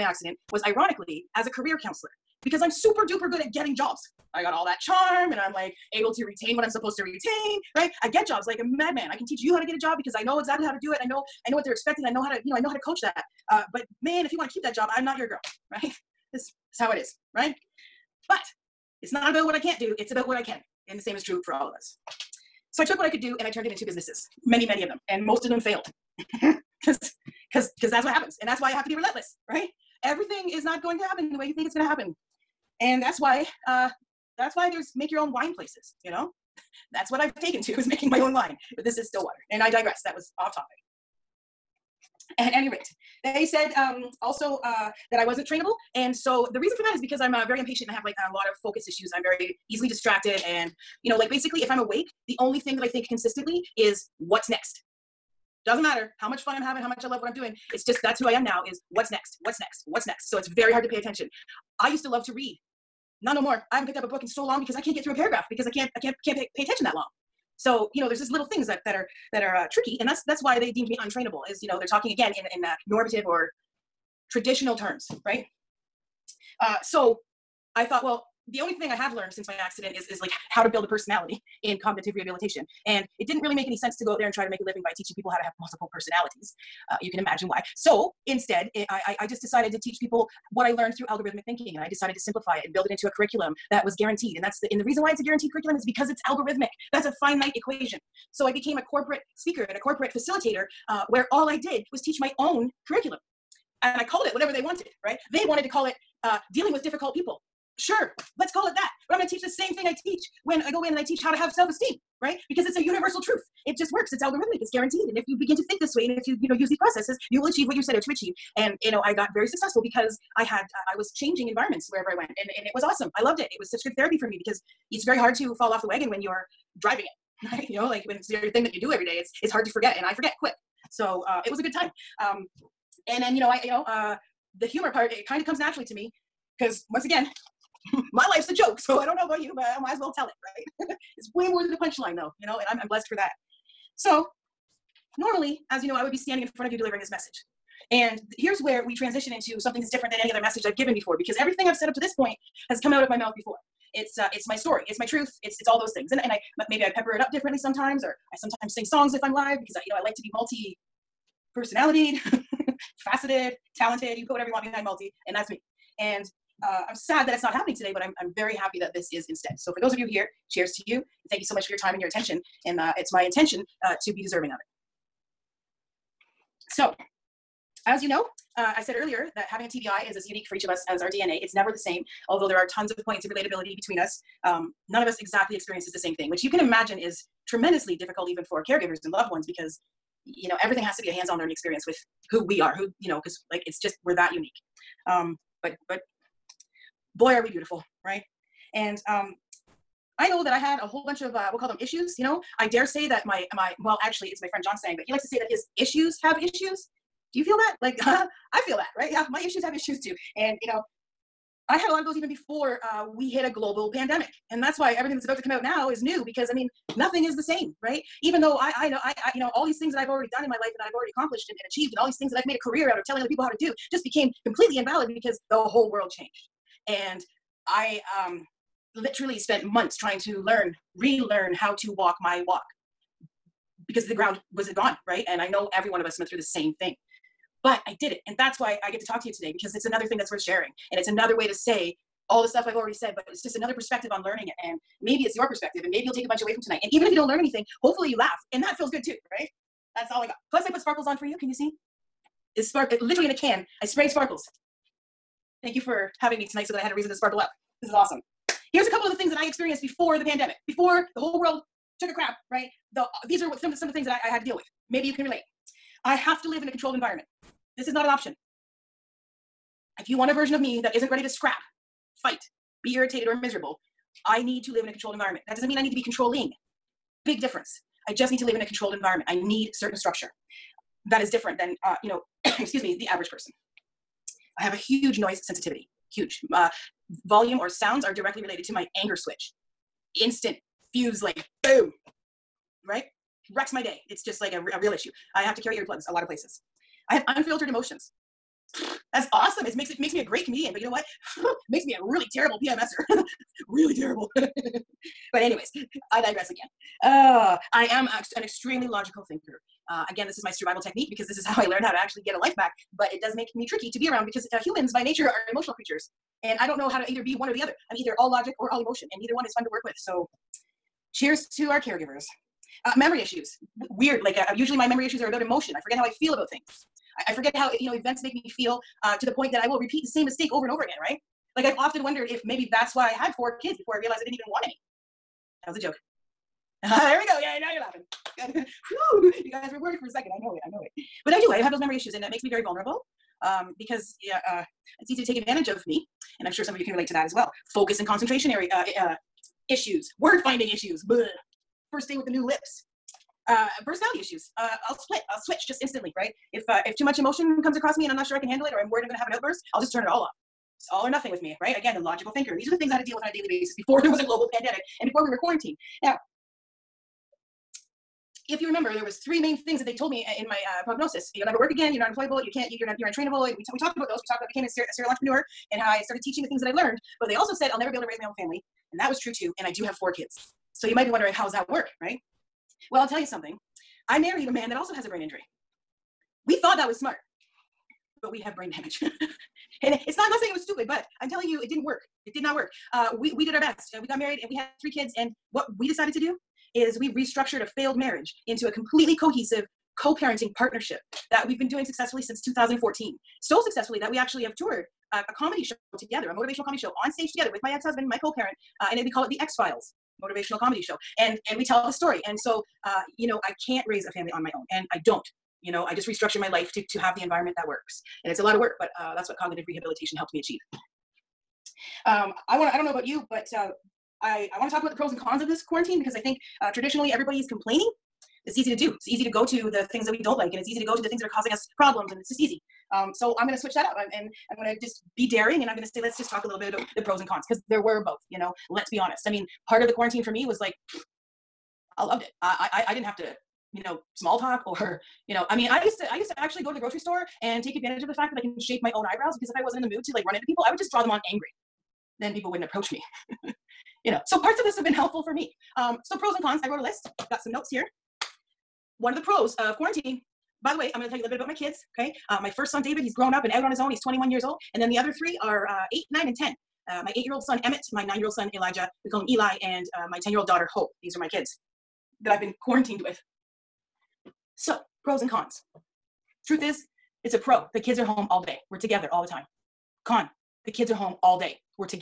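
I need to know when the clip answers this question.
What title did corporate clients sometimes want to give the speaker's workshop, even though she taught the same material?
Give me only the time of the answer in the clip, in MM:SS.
01:46.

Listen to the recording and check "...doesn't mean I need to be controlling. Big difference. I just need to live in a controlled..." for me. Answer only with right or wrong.
right.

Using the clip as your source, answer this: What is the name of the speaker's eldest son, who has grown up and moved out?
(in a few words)
David.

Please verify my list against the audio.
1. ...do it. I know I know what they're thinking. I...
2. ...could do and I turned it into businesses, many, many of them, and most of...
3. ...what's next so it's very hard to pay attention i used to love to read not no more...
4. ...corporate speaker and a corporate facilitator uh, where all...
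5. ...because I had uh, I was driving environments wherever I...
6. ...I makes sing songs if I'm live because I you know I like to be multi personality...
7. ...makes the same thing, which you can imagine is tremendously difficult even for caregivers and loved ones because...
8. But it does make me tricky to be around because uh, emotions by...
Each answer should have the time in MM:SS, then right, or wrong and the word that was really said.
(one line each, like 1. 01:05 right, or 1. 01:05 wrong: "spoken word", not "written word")
1. 00:10 wrong: "expecting", not "thinking"
2. 00:23 right
3. 00:59 right
4. 01:38 right
5. 01:59 wrong: "changing", not "driving"
6. 02:38 wrong: "sometimes", not "makes"
7. 03:05 wrong: "experiences", not "makes"
8. 05:12 wrong: "humans", not "emotions".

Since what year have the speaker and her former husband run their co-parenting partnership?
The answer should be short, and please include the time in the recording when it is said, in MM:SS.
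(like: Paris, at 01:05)
2014, at 06:42.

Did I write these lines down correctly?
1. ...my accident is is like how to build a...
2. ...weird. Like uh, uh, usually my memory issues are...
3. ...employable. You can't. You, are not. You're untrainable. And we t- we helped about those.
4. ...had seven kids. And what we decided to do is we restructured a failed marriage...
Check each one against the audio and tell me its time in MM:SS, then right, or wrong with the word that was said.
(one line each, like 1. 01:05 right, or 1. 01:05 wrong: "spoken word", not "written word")
1. 01:19 right
2. 05:23 right
3. 06:12 wrong: "talked", not "helped"
4. 06:34 wrong: "three", not "seven".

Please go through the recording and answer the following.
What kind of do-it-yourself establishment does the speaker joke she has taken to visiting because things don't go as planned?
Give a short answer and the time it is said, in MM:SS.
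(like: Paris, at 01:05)
make your own wine places, at 00:34.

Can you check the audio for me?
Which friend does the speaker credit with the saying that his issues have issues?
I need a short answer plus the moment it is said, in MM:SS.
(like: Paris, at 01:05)
John, at 03:24.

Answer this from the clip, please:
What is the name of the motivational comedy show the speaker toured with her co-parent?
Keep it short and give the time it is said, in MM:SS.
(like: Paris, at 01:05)
X Files, at 06:49.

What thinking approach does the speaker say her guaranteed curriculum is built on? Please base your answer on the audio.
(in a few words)
algorithmic thinking.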